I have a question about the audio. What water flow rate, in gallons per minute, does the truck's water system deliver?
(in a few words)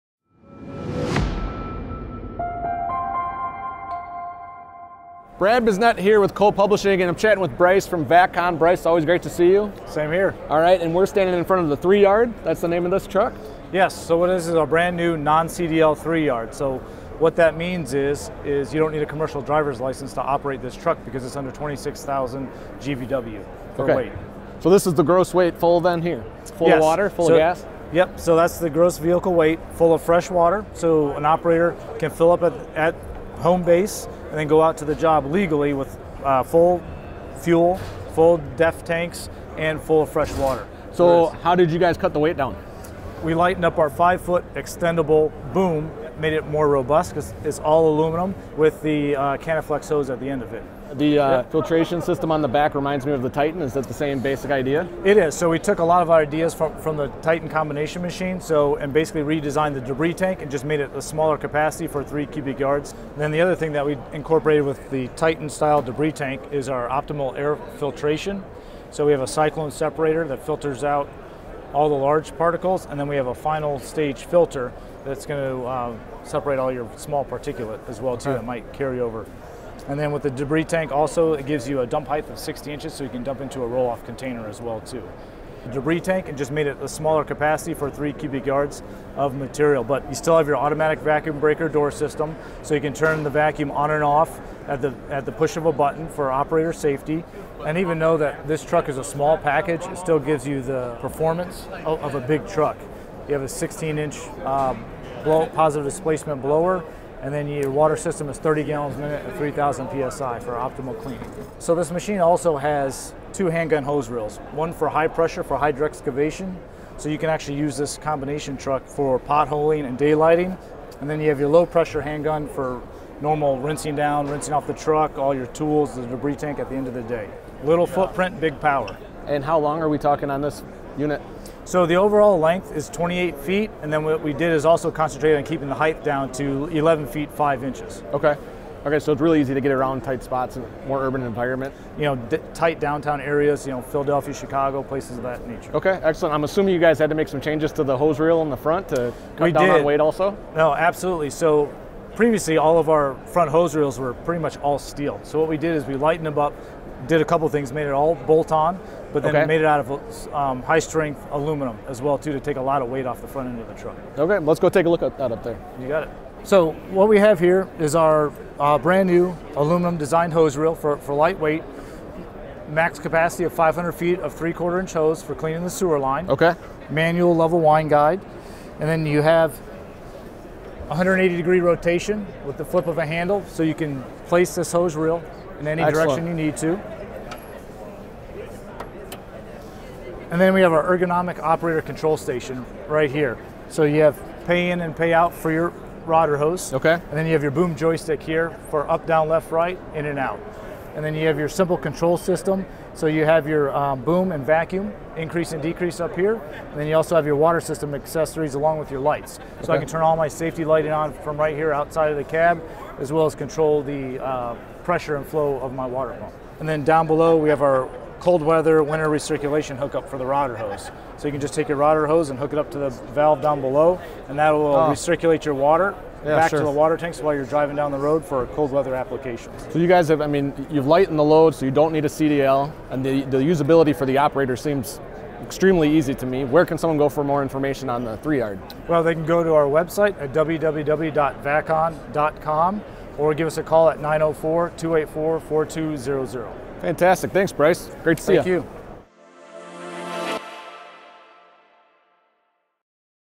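30 gallons a minute.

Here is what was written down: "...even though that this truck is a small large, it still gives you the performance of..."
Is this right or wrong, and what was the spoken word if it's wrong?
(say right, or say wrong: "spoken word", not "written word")
wrong: "package", not "large".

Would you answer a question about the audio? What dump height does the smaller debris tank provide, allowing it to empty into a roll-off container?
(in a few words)
60 inches.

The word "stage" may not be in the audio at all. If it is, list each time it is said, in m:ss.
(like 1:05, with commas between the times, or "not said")
1:13.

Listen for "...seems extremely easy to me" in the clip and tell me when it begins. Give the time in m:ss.
3:54.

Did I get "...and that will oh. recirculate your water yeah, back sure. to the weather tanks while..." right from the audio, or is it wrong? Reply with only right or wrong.
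wrong.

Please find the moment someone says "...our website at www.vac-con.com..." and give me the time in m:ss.
3:59.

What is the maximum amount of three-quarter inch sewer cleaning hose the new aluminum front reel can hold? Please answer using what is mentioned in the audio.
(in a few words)
500 feet.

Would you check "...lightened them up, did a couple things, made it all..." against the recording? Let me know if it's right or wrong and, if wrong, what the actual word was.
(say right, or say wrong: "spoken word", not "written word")
right.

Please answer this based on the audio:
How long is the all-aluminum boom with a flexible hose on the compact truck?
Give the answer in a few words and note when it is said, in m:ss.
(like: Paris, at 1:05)
5 foot, at 0:43.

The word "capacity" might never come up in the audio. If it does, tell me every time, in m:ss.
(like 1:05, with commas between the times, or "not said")
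1:01, 1:27, 2:52.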